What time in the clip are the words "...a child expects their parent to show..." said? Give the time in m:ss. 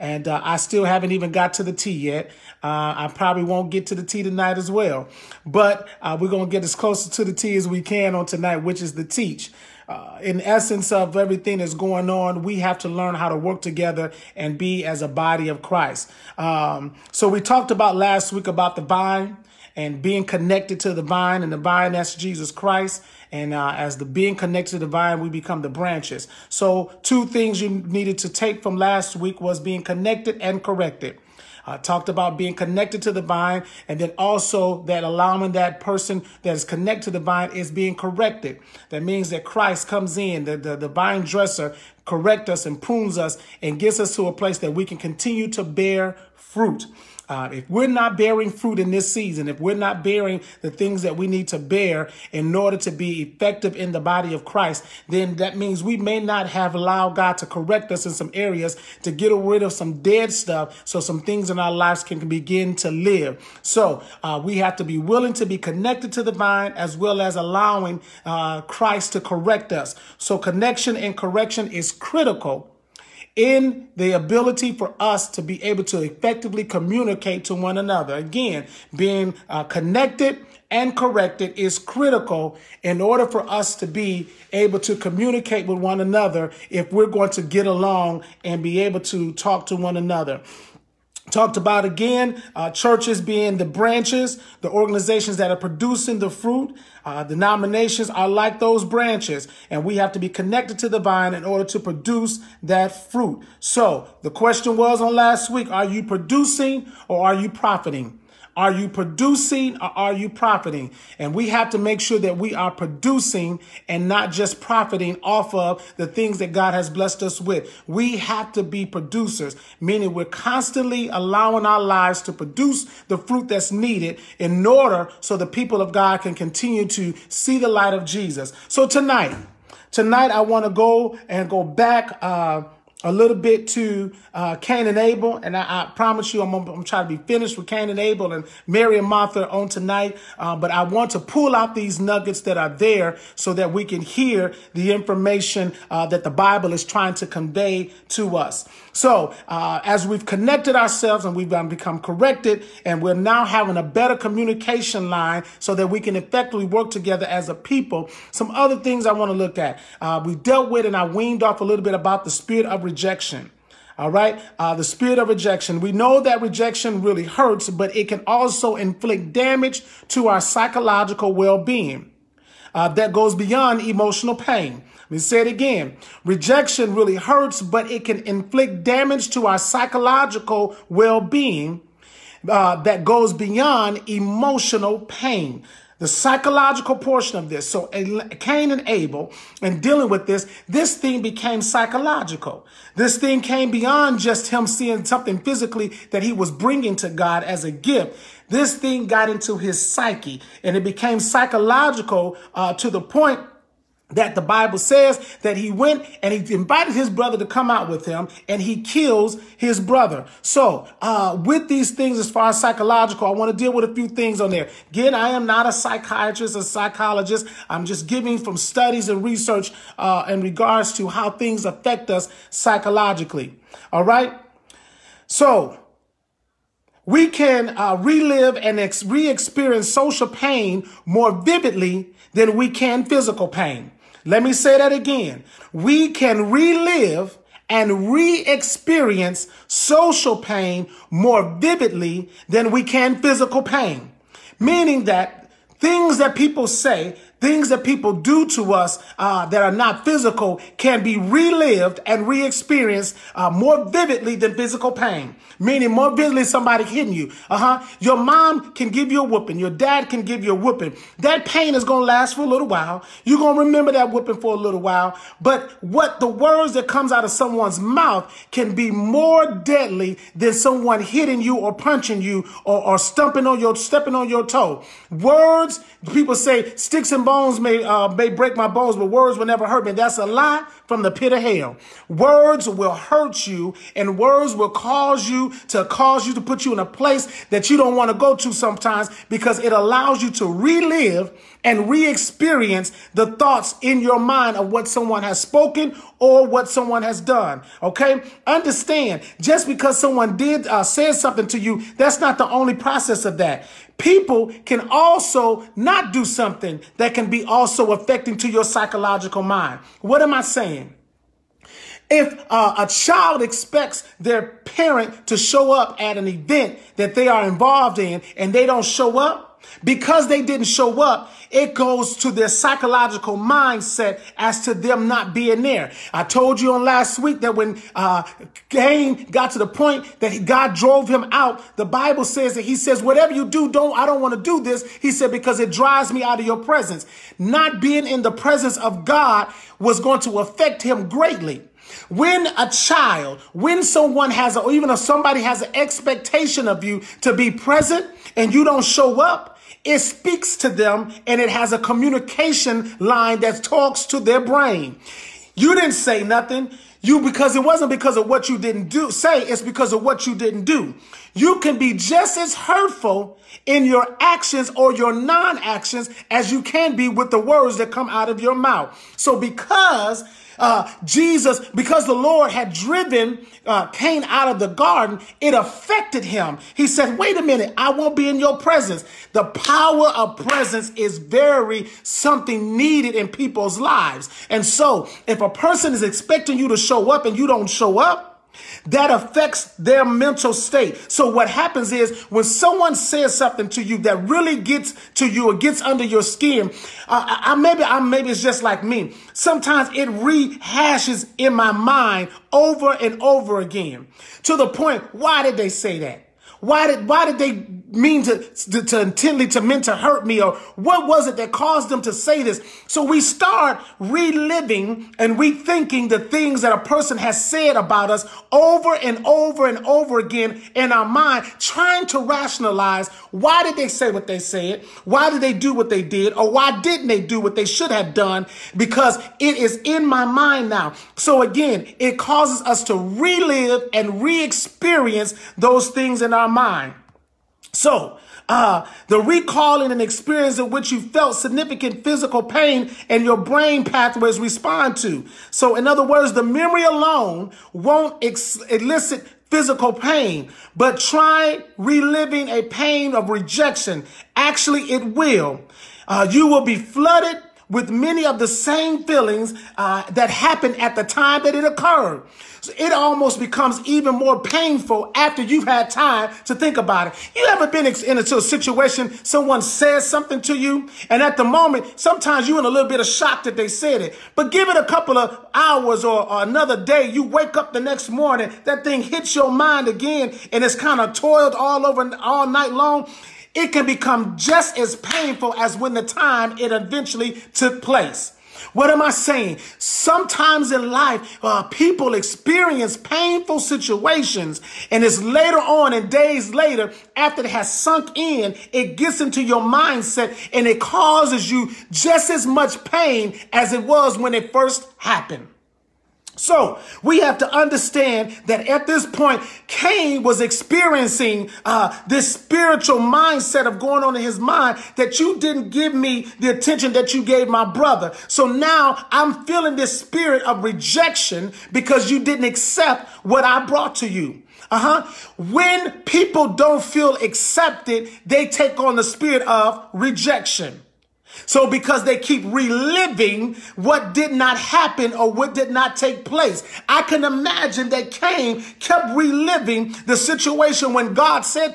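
5:12.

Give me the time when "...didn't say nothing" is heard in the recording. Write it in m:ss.
5:55.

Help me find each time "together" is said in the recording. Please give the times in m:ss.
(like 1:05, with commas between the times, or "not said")
0:13, 2:36.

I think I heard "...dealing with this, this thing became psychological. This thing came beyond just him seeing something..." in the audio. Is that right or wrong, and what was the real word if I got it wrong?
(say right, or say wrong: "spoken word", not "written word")
right.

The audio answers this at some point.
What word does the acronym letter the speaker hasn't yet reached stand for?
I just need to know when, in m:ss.
0:08.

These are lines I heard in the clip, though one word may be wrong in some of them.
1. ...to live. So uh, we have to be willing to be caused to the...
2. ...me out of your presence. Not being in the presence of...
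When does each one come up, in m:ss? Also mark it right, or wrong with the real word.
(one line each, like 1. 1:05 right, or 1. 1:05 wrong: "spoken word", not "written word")
1. 1:02 wrong: "connected", not "caused"
2. 5:36 right.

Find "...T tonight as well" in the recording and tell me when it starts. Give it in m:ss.
0:04.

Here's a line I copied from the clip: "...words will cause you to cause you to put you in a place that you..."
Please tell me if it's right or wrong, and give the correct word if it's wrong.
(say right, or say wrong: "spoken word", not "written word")
right.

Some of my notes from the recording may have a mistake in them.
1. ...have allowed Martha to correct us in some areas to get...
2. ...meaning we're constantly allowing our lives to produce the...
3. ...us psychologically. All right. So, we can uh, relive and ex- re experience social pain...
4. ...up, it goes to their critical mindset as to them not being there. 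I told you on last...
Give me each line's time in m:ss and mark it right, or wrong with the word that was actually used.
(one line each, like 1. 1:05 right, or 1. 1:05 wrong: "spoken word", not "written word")
1. 0:56 wrong: "God", not "Martha"
2. 1:59 right
3. 3:42 right
4. 5:21 wrong: "psychological", not "critical".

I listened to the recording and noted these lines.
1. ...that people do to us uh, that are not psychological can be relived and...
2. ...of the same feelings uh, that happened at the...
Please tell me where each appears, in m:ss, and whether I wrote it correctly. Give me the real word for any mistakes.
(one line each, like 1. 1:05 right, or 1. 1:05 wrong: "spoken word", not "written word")
1. 4:07 wrong: "physical", not "psychological"
2. 7:38 right.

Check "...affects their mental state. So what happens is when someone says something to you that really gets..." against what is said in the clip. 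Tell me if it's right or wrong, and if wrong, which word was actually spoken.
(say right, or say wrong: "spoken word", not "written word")
right.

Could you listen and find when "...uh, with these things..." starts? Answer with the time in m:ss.
3:31.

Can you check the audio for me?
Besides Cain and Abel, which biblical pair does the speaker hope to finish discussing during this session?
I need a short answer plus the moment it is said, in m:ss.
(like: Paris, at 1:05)
Mary and Martha, at 2:18.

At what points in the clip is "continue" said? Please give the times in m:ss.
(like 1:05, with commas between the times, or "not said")
0:44, 2:06.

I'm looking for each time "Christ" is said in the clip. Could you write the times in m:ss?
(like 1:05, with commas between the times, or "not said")
0:15, 0:22, 0:39, 0:54, 1:08.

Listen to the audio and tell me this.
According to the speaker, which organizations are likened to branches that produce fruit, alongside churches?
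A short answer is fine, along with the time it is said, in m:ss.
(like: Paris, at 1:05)
denominations, at 1:37.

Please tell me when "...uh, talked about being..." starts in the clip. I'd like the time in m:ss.
0:31.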